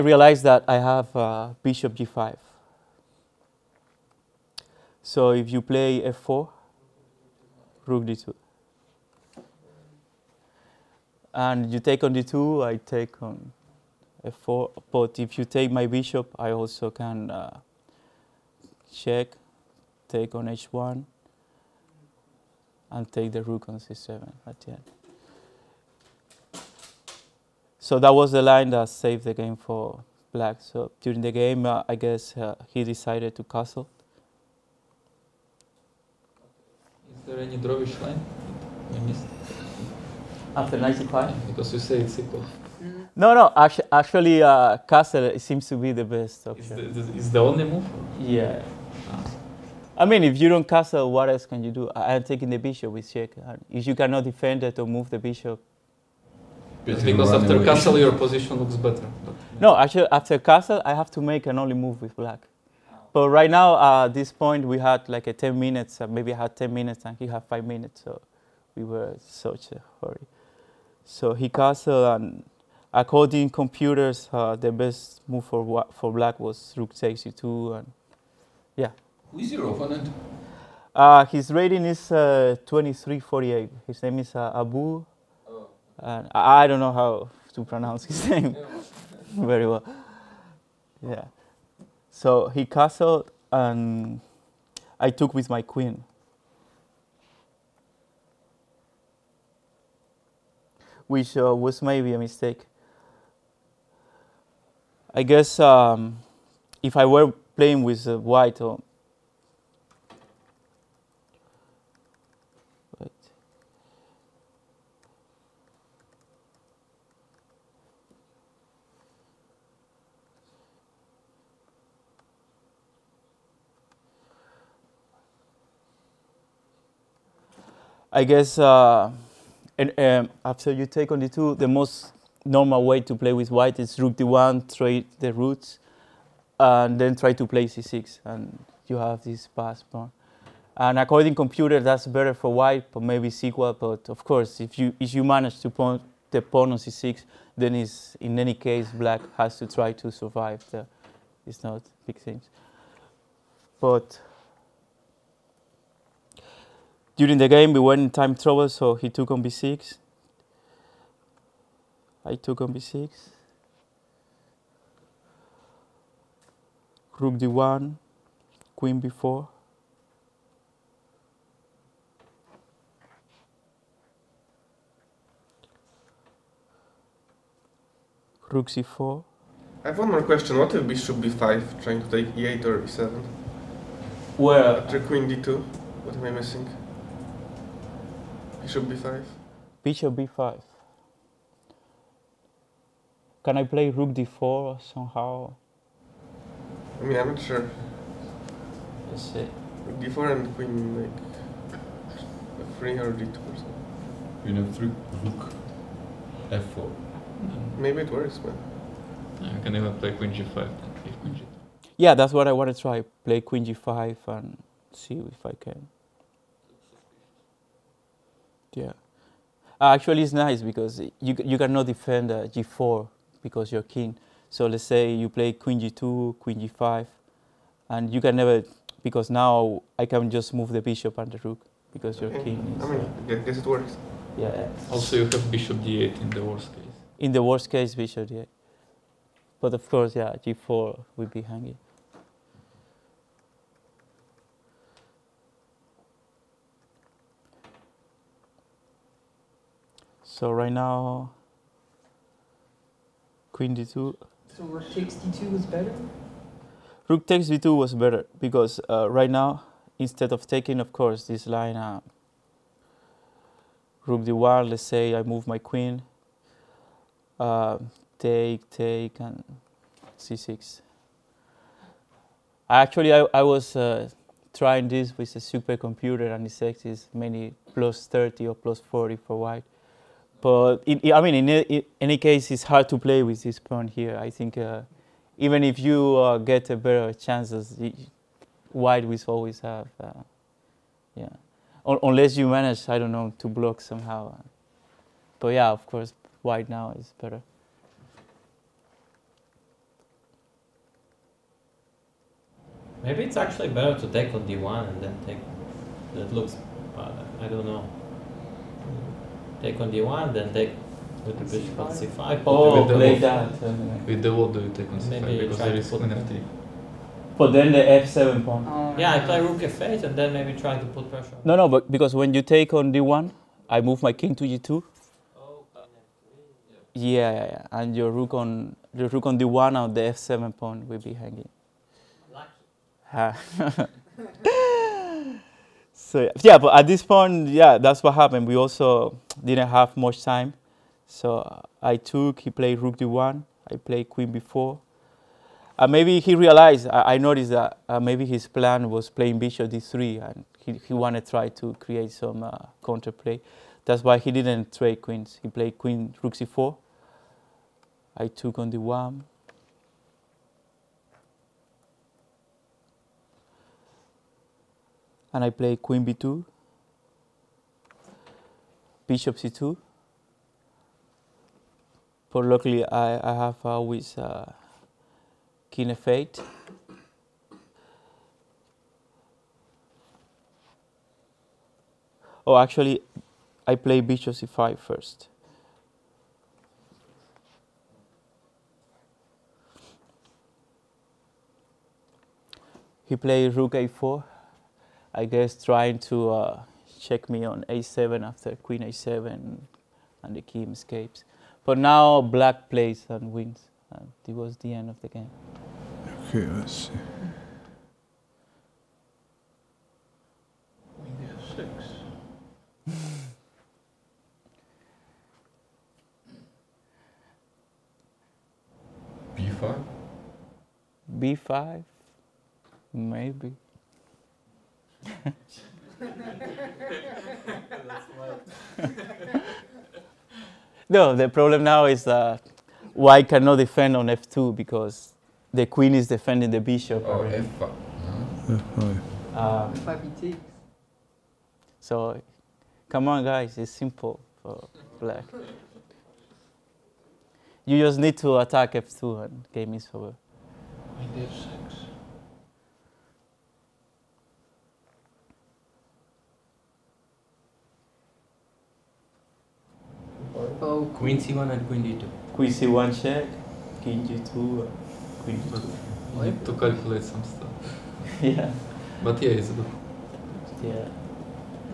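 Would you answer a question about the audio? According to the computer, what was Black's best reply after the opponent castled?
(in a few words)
Rook takes e2.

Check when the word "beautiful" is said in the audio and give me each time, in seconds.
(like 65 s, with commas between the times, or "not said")
not said.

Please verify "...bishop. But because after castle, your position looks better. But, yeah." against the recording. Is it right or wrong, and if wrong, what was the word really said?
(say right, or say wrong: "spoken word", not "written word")
right.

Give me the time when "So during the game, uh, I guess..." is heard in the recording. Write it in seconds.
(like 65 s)
30 s.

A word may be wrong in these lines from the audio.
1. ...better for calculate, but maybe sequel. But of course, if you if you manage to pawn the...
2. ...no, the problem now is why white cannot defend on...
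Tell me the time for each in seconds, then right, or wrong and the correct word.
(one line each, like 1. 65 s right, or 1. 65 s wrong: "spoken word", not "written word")
1. 142 s wrong: "white", not "calculate"
2. 430 s right.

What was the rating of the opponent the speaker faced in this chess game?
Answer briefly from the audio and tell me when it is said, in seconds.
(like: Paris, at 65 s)
2348, at 82 s.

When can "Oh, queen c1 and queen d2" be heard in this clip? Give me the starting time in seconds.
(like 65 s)
460 s.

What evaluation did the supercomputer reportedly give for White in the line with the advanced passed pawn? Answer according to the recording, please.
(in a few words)
plus 30 or plus 40.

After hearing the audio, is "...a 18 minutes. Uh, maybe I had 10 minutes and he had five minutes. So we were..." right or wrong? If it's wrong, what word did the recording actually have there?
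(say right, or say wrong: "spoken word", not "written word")
wrong: "10", not "18".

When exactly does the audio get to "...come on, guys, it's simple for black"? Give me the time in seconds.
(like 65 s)
442 s.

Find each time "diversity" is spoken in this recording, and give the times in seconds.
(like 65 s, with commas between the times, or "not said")
not said.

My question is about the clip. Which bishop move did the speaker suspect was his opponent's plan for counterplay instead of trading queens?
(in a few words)
Bishop d3.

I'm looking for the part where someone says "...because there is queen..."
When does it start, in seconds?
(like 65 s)
315 s.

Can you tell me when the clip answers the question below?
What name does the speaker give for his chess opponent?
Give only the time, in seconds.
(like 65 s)
84 s.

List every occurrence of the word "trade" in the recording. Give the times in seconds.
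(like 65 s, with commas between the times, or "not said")
134 s, 354 s.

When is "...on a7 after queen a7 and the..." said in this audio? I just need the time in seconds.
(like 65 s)
397 s.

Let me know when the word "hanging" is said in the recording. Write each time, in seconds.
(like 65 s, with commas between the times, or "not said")
241 s, 331 s.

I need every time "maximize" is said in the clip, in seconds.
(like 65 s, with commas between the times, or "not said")
not said.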